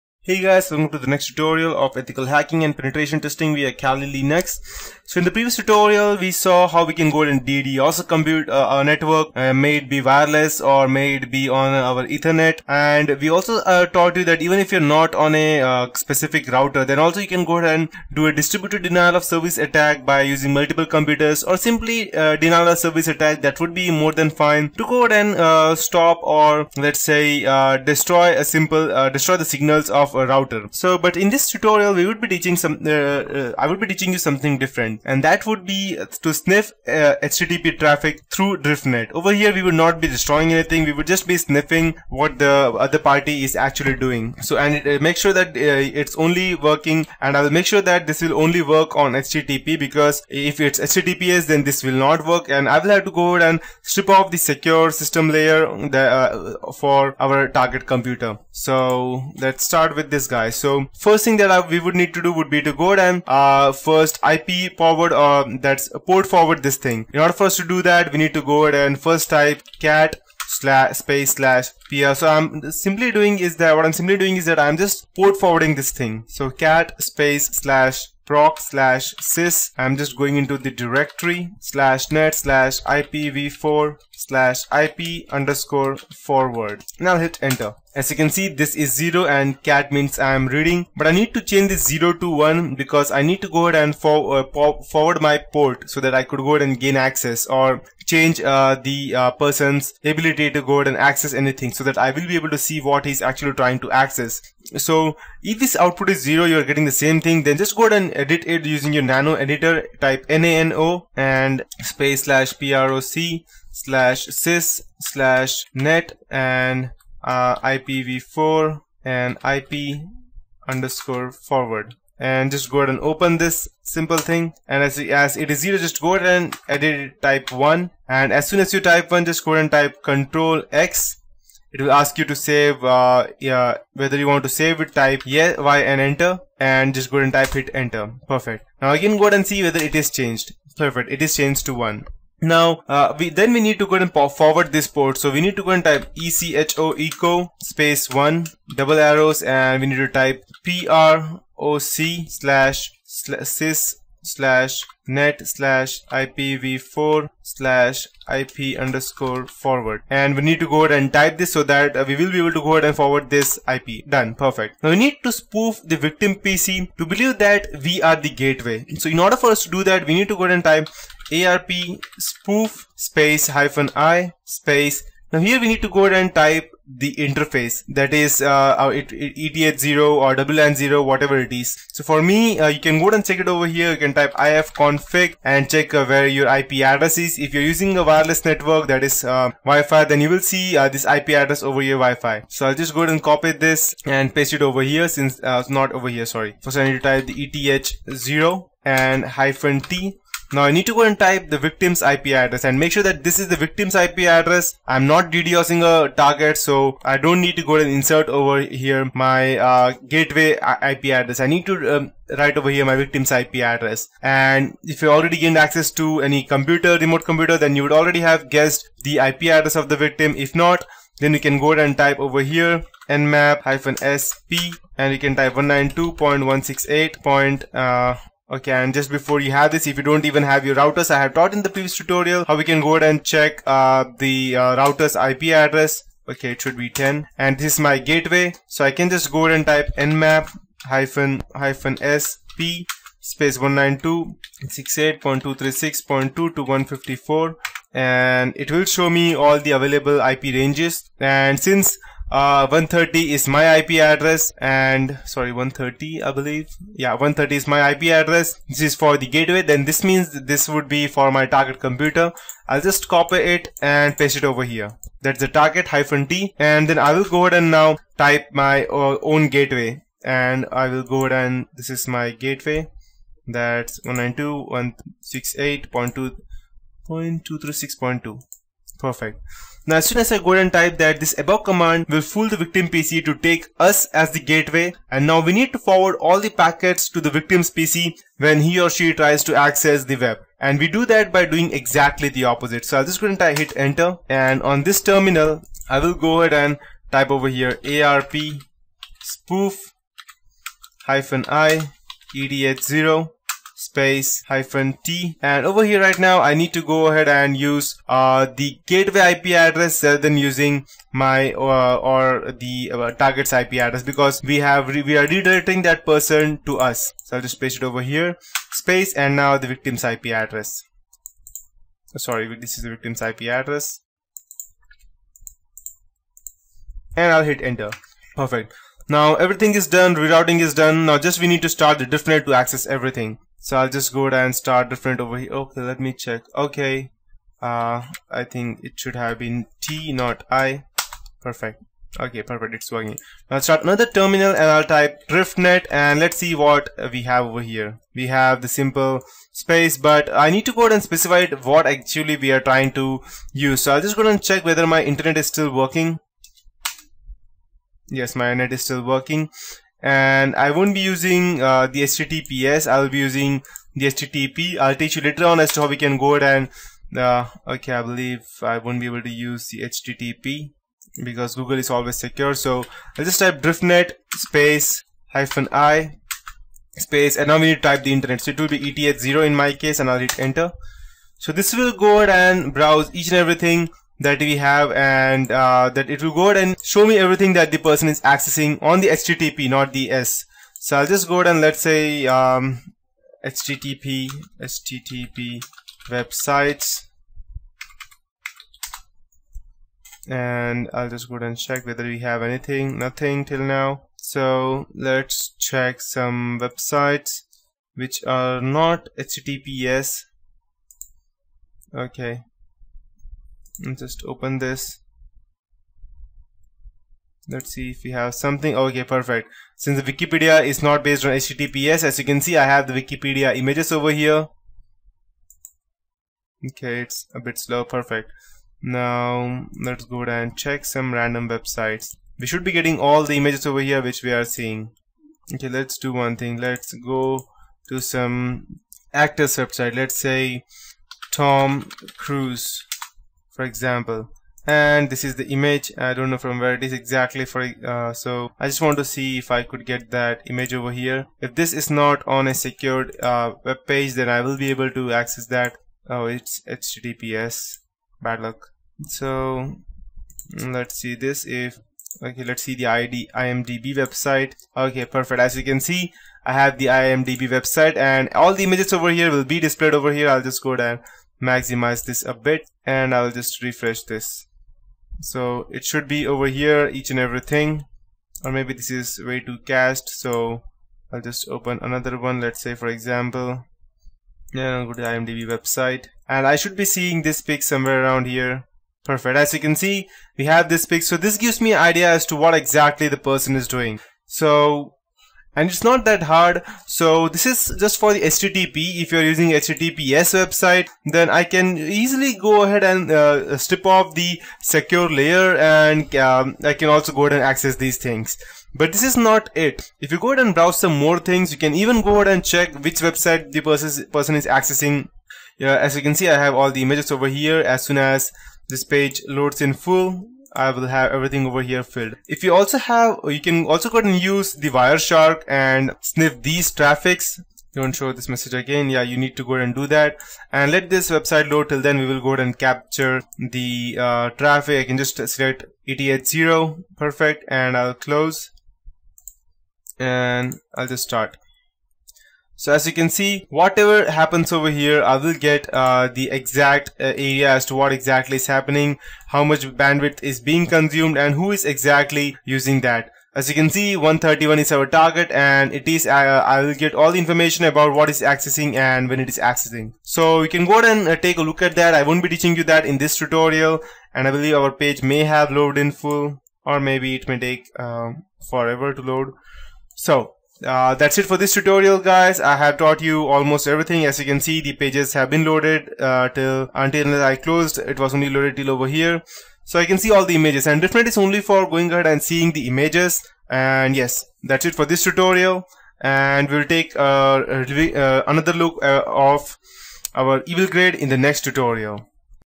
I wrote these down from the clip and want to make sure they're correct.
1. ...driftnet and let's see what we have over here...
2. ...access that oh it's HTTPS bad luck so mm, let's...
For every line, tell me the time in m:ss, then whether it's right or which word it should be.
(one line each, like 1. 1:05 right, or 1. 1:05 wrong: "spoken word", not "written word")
1. 5:45 right
2. 7:35 right.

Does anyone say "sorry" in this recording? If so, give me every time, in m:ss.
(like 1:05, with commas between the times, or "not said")
3:16, 4:15, 5:22.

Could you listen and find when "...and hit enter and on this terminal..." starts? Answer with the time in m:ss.
4:53.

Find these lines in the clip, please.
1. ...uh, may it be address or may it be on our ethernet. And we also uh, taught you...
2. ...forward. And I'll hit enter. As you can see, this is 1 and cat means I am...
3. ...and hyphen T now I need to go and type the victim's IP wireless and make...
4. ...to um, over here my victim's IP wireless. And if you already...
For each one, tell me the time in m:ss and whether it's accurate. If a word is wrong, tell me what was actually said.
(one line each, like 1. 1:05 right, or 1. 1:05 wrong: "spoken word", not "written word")
1. 0:09 wrong: "wireless", not "address"
2. 1:25 wrong: "0", not "1"
3. 3:18 wrong: "address", not "wireless"
4. 3:31 wrong: "address", not "wireless".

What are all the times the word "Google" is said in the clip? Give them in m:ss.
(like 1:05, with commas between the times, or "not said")
6:11.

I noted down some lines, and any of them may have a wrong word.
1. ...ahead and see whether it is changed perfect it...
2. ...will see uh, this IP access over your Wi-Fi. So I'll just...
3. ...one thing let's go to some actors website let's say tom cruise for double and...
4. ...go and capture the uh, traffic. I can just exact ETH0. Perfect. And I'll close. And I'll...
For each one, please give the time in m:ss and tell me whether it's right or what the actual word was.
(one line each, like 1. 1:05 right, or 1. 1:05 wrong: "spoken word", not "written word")
1. 2:19 right
2. 3:10 wrong: "address", not "access"
3. 7:16 wrong: "example", not "double"
4. 8:52 wrong: "select", not "exact".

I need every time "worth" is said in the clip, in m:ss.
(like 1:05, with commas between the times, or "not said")
not said.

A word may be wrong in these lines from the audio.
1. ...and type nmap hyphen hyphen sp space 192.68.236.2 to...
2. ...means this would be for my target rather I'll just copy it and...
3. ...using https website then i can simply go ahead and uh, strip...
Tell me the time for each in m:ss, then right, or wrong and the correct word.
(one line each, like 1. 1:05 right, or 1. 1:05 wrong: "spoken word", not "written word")
1. 3:59 right
2. 4:20 wrong: "computer", not "rather"
3. 8:19 wrong: "easily", not "simply".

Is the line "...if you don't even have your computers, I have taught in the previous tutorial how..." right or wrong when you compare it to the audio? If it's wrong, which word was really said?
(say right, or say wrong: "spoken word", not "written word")
wrong: "routers", not "computers".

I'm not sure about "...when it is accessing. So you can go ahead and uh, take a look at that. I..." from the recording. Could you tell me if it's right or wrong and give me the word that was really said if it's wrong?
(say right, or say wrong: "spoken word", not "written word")
right.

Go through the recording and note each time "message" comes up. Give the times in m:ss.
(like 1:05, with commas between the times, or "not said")
8:48.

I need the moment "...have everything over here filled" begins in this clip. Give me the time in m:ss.
8:40.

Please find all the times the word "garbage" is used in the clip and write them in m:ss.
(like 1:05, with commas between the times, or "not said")
not said.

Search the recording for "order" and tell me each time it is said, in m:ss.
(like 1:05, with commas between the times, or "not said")
1:07, 2:49.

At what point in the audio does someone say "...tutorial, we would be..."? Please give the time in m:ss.
0:31.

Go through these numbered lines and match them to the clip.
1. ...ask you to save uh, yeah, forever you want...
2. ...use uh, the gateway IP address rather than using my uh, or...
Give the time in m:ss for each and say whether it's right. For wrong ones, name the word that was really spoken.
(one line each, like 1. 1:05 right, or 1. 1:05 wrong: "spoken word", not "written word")
1. 2:11 wrong: "whether", not "forever"
2. 5:07 right.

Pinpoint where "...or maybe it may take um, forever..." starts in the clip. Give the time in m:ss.
9:26.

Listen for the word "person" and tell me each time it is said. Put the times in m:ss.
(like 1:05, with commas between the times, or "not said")
1:39, 5:16, 6:27, 8:13, 8:33.